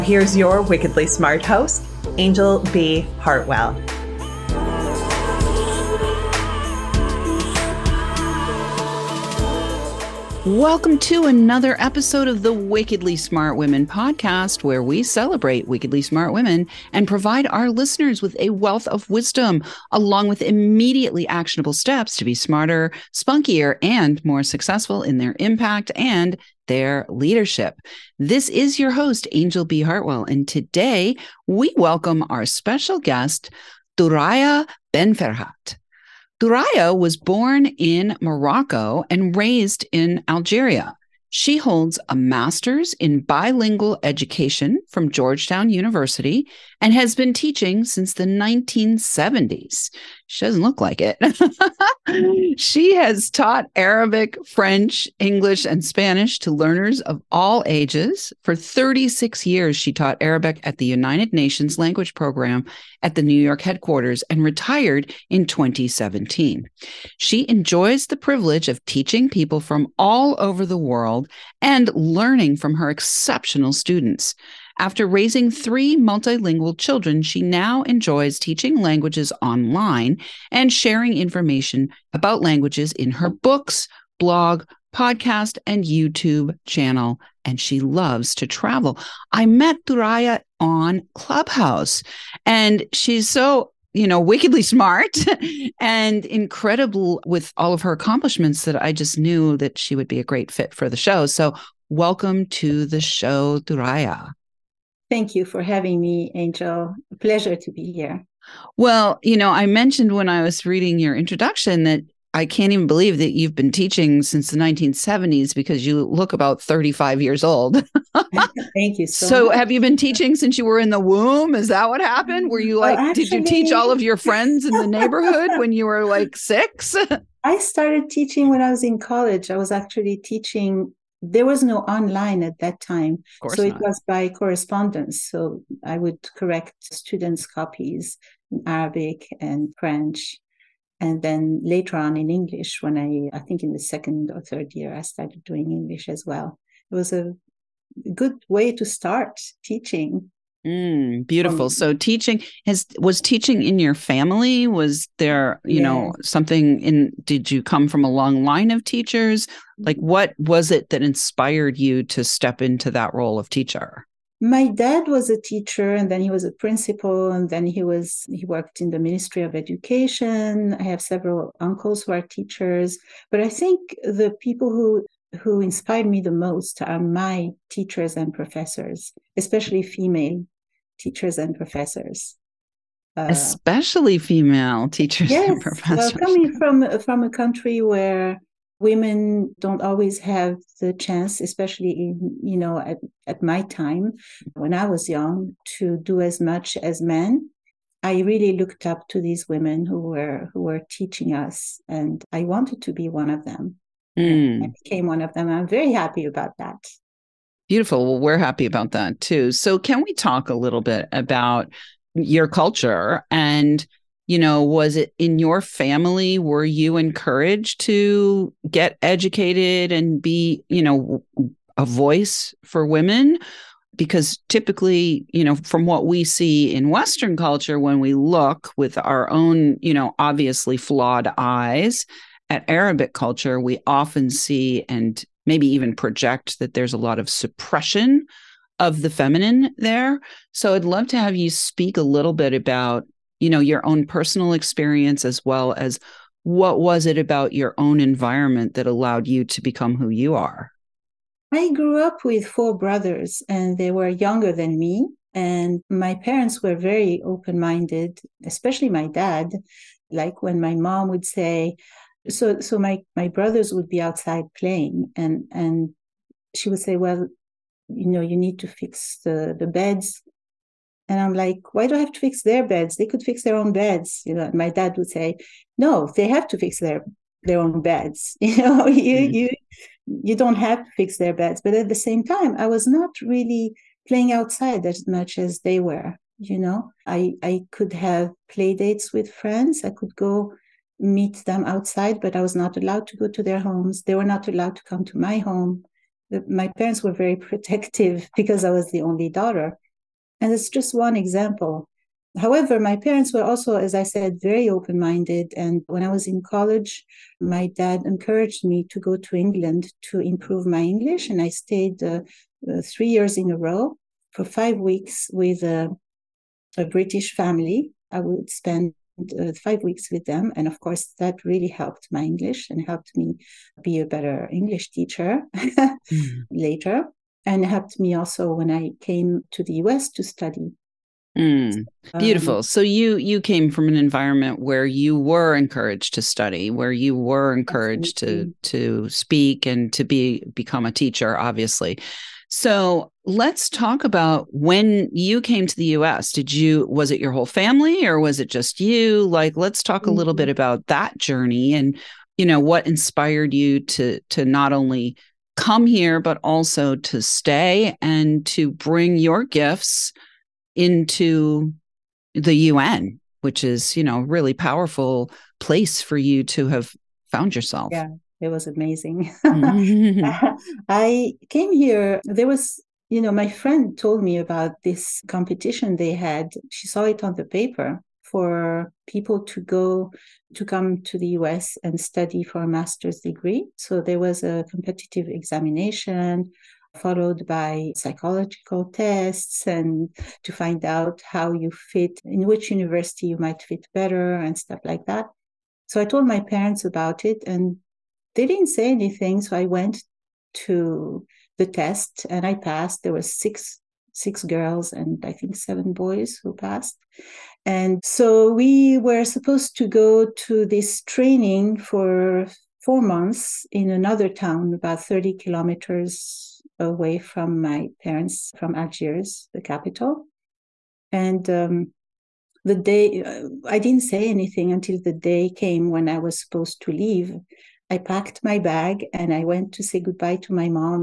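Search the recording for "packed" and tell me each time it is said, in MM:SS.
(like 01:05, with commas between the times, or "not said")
07:07.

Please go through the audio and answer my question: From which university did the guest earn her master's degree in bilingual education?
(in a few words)
Georgetown University.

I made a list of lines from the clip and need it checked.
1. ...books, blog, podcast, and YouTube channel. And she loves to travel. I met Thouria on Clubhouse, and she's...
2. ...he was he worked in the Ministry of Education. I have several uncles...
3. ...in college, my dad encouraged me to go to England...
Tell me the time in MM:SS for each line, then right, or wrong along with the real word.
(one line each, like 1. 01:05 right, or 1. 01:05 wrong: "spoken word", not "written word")
1. 01:23 right
2. 02:47 right
3. 05:06 right.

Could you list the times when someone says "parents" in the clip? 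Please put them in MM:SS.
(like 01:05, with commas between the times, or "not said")
04:16, 04:56, 05:02, 06:36, 06:58.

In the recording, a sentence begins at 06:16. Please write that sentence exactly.
She saw it on the paper for people to go to come to the US and study for a master's degree.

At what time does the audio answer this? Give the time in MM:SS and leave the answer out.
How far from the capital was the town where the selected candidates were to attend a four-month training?
06:55.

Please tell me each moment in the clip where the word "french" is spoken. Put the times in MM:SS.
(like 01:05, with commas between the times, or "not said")
00:54, 02:19.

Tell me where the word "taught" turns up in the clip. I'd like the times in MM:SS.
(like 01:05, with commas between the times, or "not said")
00:53, 00:59.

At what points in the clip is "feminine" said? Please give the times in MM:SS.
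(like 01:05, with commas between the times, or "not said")
03:59.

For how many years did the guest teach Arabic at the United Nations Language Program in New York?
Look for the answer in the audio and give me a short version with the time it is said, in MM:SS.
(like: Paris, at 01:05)
36, at 00:58.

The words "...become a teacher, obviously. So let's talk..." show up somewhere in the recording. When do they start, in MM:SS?
05:40.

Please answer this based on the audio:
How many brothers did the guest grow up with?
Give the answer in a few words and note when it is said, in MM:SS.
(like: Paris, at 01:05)
4, at 04:12.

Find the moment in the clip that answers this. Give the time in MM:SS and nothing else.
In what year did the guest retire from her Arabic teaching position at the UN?
01:05.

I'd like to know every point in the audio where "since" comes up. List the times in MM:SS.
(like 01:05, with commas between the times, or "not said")
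00:47, 01:54, 02:00.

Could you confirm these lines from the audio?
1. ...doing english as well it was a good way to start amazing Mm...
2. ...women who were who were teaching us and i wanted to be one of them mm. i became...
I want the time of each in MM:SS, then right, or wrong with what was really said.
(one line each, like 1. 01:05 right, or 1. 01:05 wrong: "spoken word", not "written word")
1. 02:25 wrong: "teaching", not "amazing"
2. 03:19 right.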